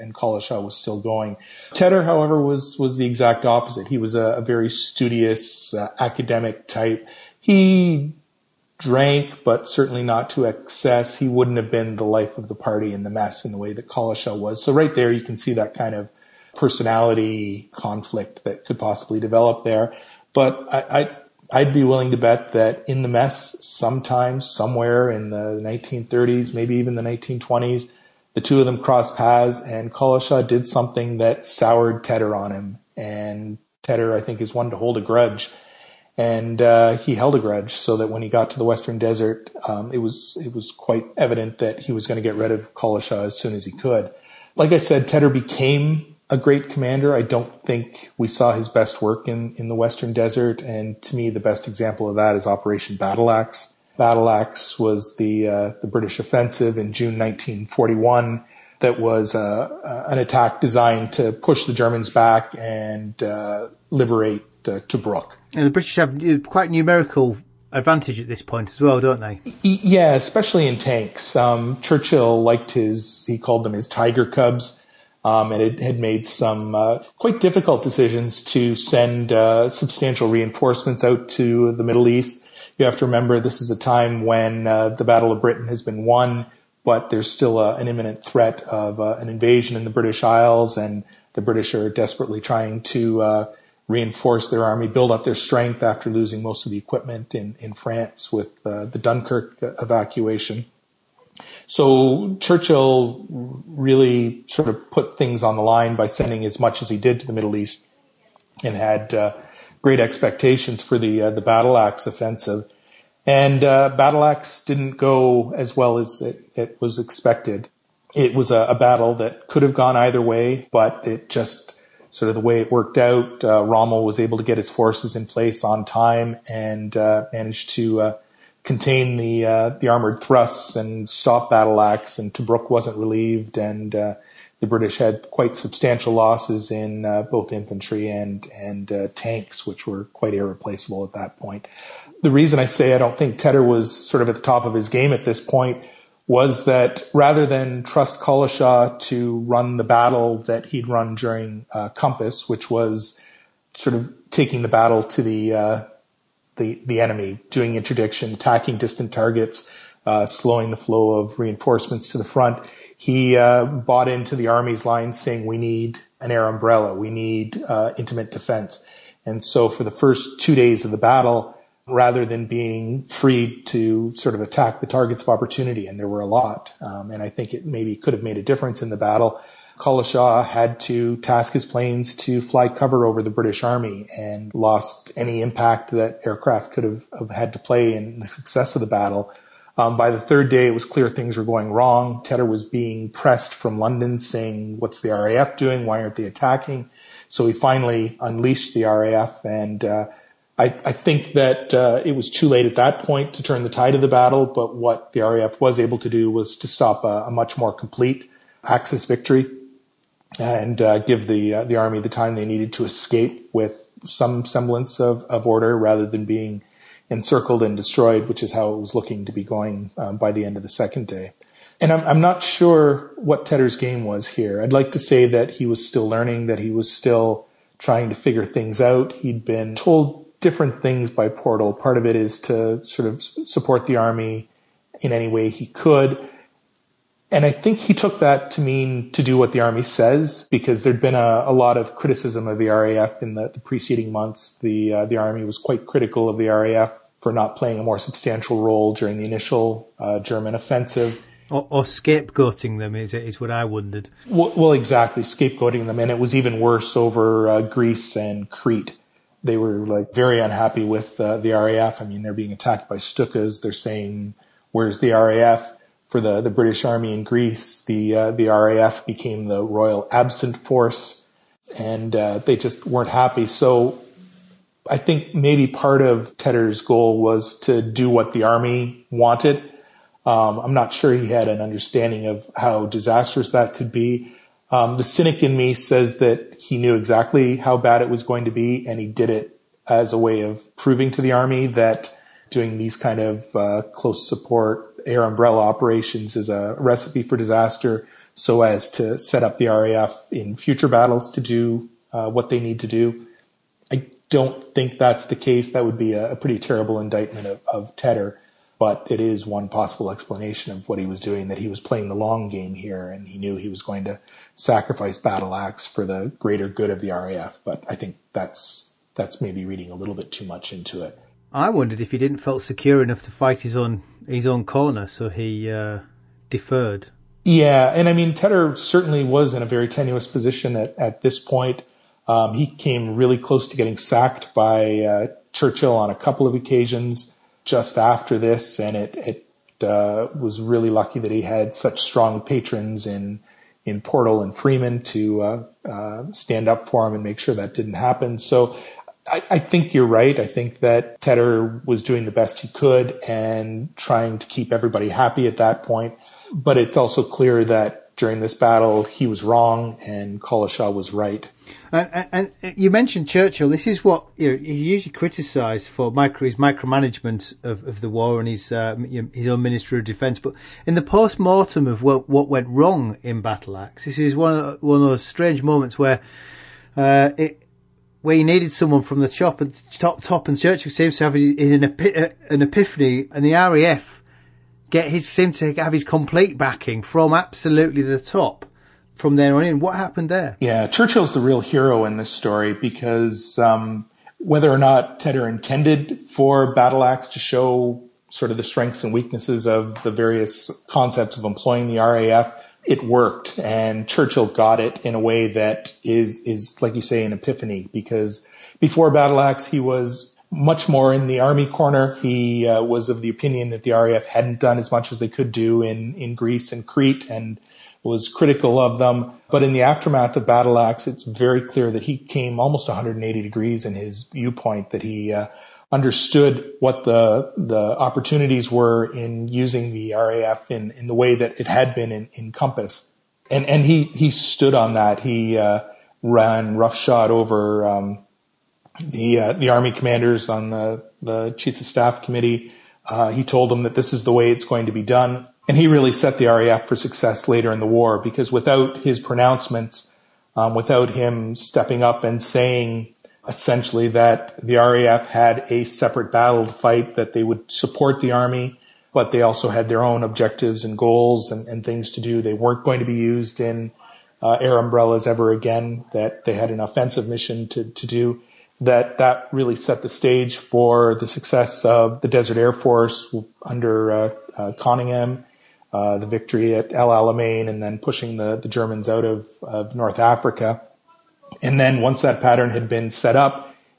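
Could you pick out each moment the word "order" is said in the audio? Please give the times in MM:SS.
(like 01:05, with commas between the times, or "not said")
03:35.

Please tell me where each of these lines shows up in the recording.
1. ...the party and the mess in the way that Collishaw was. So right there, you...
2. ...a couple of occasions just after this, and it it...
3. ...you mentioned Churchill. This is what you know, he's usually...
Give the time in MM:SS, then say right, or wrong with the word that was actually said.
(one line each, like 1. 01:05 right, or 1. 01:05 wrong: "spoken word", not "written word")
1. 00:12 right
2. 05:36 right
3. 06:02 right.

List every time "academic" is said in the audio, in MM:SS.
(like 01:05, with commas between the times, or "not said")
00:05.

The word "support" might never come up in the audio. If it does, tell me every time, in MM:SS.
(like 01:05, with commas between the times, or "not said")
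03:53, 04:54, 07:37.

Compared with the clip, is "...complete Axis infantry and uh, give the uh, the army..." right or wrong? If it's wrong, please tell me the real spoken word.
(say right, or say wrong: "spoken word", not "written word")
wrong: "victory", not "infantry".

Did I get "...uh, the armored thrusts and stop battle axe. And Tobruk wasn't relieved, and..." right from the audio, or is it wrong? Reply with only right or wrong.
right.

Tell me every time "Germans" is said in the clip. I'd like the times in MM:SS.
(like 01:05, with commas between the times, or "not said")
01:01, 04:10, 07:58.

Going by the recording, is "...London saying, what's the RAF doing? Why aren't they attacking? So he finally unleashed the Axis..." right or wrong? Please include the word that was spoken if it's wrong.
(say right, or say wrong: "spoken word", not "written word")
wrong: "RAF", not "Axis".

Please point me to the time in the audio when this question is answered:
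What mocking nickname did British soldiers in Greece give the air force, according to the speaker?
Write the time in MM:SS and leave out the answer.
04:29.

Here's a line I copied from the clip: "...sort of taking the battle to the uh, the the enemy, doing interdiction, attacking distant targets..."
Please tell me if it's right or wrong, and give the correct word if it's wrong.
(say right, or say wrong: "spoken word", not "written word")
right.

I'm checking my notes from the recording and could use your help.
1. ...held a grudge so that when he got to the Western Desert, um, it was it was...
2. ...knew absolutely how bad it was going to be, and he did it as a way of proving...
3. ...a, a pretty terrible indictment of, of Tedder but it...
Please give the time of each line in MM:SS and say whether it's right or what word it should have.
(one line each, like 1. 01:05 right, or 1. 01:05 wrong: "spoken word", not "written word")
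1. 00:37 right
2. 04:46 wrong: "exactly", not "absolutely"
3. 05:06 right.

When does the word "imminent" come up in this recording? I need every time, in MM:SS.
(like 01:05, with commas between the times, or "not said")
01:27.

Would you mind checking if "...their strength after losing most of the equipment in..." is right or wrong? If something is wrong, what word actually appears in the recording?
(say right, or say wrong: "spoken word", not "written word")
right.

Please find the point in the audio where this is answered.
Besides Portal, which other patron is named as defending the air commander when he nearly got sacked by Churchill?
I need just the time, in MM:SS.
05:44.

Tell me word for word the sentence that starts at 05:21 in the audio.
I wondered if he didn't feel secure enough to fight his own his own corner, so he uh, deferred.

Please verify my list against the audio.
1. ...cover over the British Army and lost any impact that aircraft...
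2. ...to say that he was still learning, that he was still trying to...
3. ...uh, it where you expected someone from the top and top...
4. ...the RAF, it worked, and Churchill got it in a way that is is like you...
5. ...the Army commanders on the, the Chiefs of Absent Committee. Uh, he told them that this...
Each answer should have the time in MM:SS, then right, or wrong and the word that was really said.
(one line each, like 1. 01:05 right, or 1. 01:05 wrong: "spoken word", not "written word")
1. 03:02 right
2. 03:44 right
3. 06:16 wrong: "needed", not "expected"
4. 06:41 right
5. 07:19 wrong: "Staff", not "Absent".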